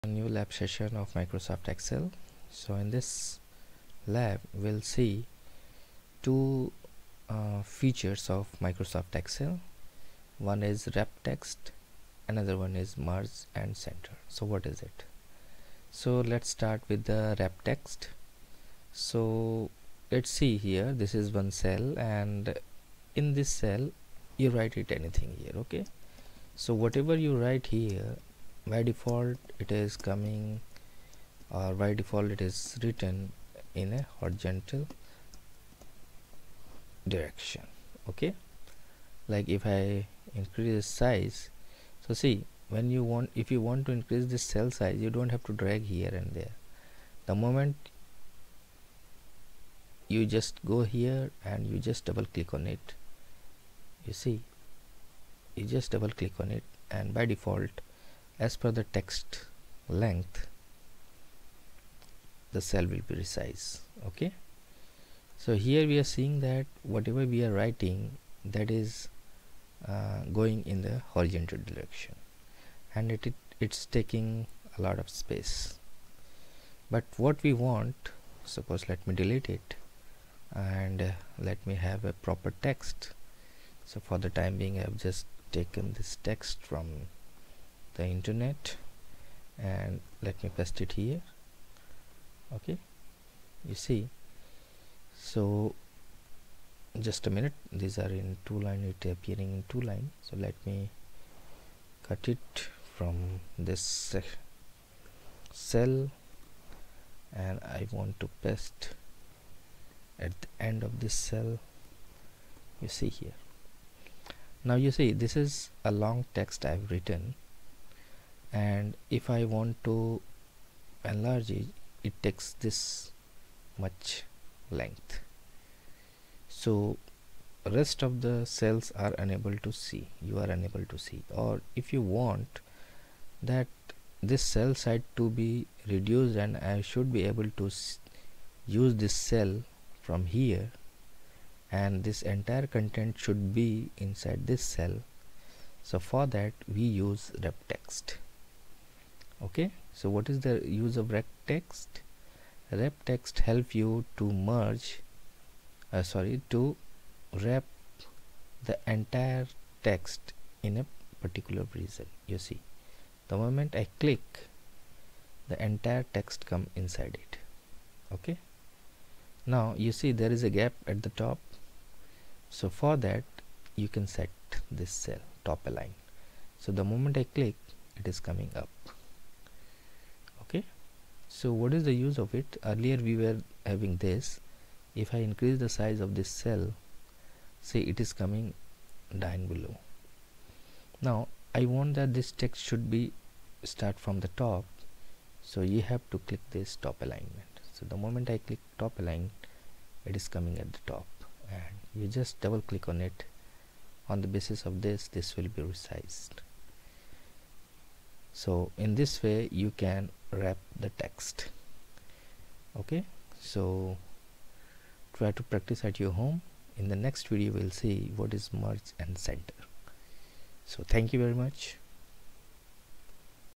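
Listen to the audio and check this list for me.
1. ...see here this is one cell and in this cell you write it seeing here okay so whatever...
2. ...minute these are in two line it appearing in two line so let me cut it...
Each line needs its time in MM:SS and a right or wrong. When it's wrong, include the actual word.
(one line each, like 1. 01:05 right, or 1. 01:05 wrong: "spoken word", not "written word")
1. 00:20 wrong: "anything", not "seeing"
2. 01:37 right.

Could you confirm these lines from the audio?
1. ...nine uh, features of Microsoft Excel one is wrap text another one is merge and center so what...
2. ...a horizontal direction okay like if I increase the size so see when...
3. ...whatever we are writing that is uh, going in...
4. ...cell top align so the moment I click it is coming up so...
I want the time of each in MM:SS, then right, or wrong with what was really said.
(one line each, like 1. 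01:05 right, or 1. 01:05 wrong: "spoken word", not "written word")
1. 00:06 wrong: "two", not "nine"
2. 00:33 right
3. 01:06 right
4. 02:54 right.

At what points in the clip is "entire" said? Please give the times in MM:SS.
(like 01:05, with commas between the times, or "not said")
02:22, 02:38, 02:45.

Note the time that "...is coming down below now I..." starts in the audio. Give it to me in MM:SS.
03:08.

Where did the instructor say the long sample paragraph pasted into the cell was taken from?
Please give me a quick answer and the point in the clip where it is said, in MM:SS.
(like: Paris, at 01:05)
The internet, at 01:28.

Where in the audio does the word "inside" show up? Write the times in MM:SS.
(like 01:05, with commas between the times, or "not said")
02:23, 02:46.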